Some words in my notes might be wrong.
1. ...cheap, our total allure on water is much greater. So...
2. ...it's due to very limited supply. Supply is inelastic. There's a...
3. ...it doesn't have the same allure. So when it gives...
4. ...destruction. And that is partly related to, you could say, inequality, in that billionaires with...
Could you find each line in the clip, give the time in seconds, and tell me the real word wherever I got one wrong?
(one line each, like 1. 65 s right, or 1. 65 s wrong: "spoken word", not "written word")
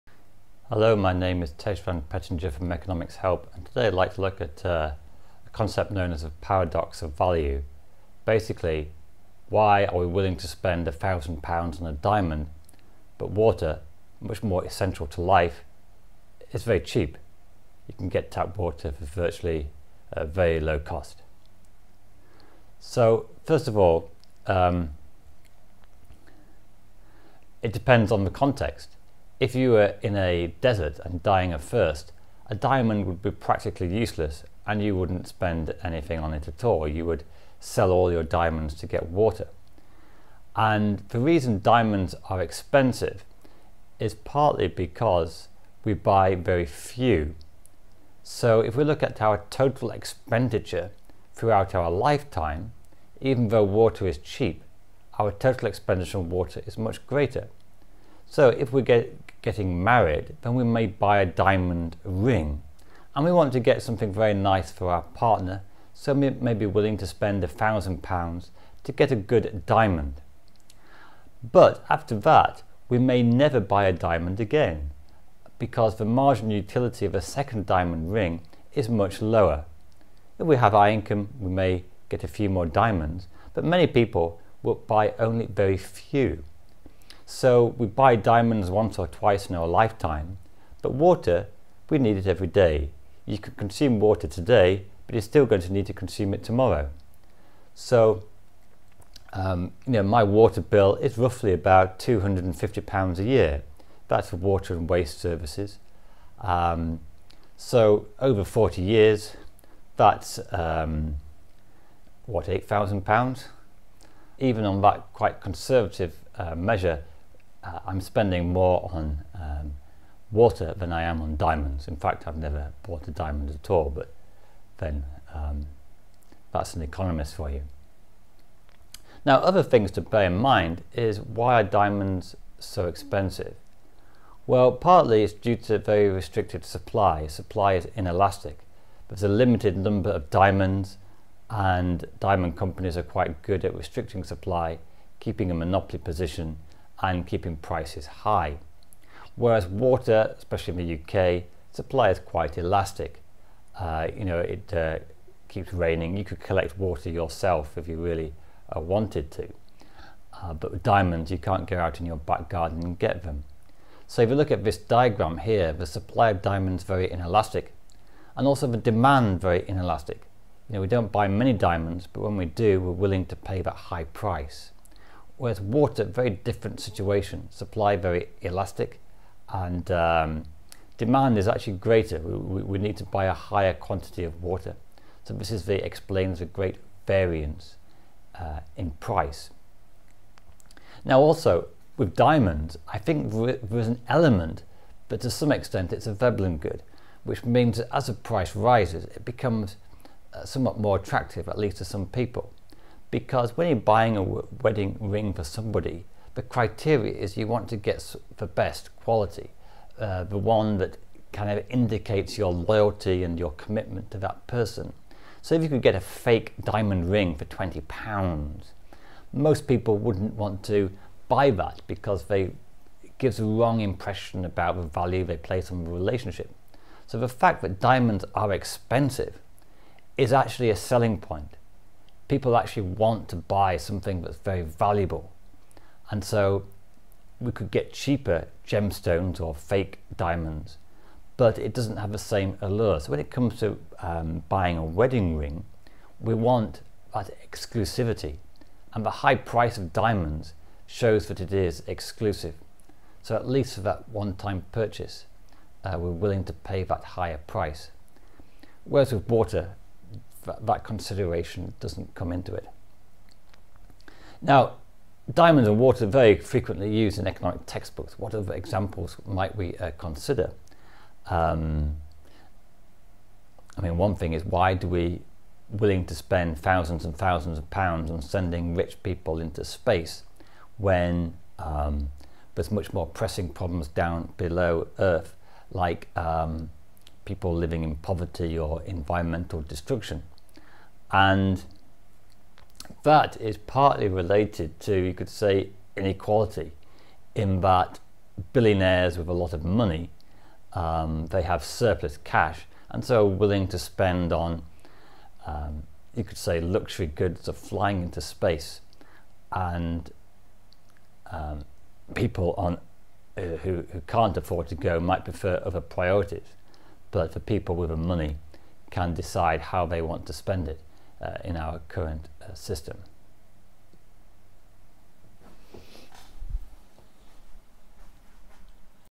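1. 54 s wrong: "expenditure", not "allure"
2. 135 s wrong: "restricted", not "limited"
3. 241 s wrong: "comes", not "gives"
4. 289 s right.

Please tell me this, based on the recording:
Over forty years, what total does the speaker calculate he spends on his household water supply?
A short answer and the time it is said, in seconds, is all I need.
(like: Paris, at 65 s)
£8,000, at 112 s.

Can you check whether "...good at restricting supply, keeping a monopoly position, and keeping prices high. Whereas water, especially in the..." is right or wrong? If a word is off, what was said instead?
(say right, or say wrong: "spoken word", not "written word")
right.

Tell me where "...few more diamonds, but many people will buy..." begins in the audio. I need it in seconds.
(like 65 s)
82 s.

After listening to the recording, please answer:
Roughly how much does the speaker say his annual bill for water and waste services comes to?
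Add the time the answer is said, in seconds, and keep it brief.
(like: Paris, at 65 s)
£250, at 101 s.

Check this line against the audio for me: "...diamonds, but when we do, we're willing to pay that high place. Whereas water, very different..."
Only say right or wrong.
wrong.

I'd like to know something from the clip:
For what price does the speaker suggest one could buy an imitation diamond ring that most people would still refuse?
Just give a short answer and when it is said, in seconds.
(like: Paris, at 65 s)
20 pounds, at 217 s.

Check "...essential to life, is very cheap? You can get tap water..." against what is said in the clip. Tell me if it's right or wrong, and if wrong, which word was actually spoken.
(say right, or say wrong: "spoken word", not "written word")
right.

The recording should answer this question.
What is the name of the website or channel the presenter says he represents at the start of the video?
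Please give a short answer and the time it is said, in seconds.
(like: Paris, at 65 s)
Economics Help, at 2 s.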